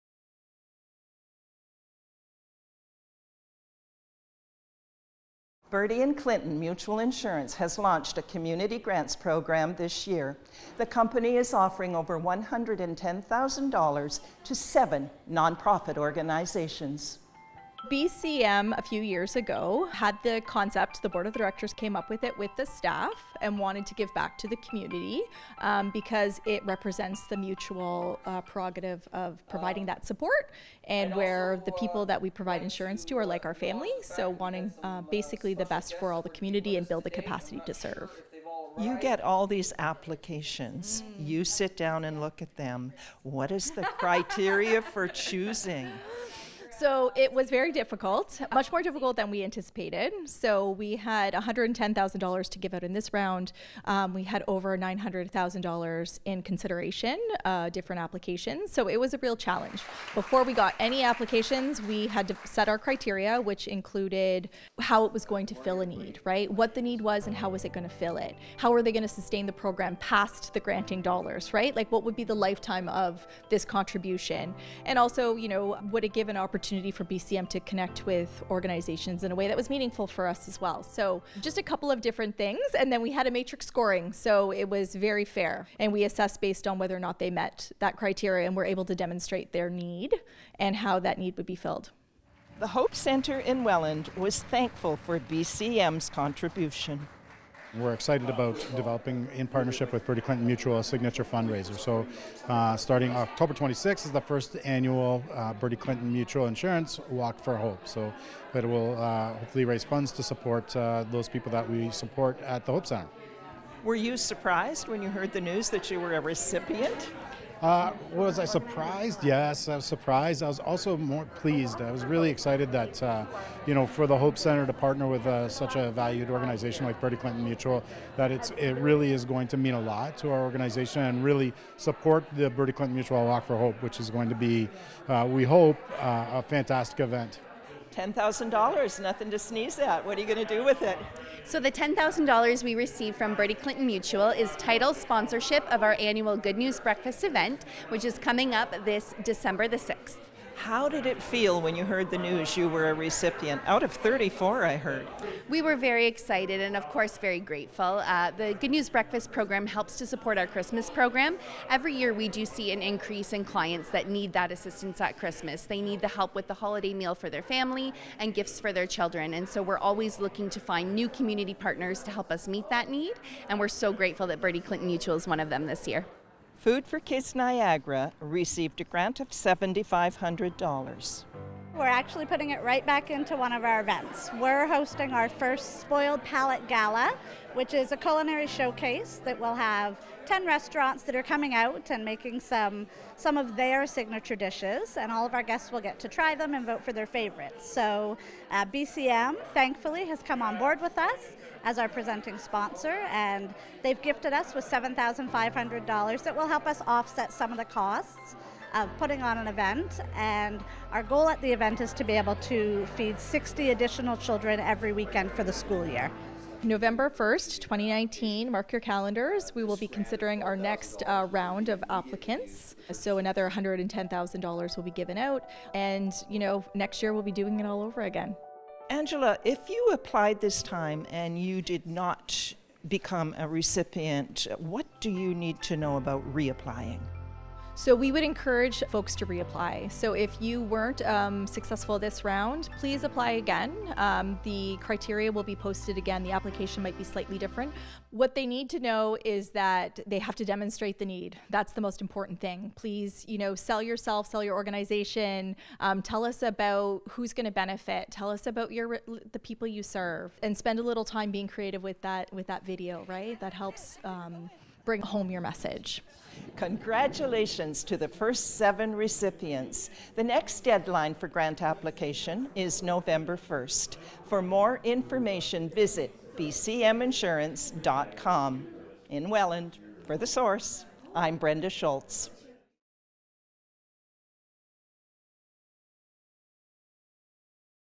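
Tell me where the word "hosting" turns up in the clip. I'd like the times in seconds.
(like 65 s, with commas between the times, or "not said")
184 s.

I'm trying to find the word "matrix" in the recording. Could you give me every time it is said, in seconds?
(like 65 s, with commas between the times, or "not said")
83 s.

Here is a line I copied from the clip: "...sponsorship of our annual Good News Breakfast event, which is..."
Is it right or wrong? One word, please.
right.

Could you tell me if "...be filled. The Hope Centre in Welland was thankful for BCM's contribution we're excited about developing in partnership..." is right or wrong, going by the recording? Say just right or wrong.
right.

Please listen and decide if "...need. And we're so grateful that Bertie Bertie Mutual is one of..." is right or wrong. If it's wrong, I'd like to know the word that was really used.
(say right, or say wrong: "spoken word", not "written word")
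wrong: "Clinton", not "Bertie".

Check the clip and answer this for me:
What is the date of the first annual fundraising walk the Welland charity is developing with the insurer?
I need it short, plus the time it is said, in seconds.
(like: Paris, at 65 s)
October 26, at 103 s.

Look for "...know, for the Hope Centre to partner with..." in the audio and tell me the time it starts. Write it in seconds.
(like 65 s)
123 s.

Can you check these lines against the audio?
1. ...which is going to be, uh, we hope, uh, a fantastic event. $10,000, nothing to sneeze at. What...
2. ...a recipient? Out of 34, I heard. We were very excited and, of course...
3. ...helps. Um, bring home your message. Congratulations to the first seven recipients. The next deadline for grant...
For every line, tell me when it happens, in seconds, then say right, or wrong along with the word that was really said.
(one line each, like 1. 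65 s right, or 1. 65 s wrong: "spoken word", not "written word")
1. 133 s right
2. 152 s right
3. 263 s right.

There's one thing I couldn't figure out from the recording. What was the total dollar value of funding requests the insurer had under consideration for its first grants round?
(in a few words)
$900,000.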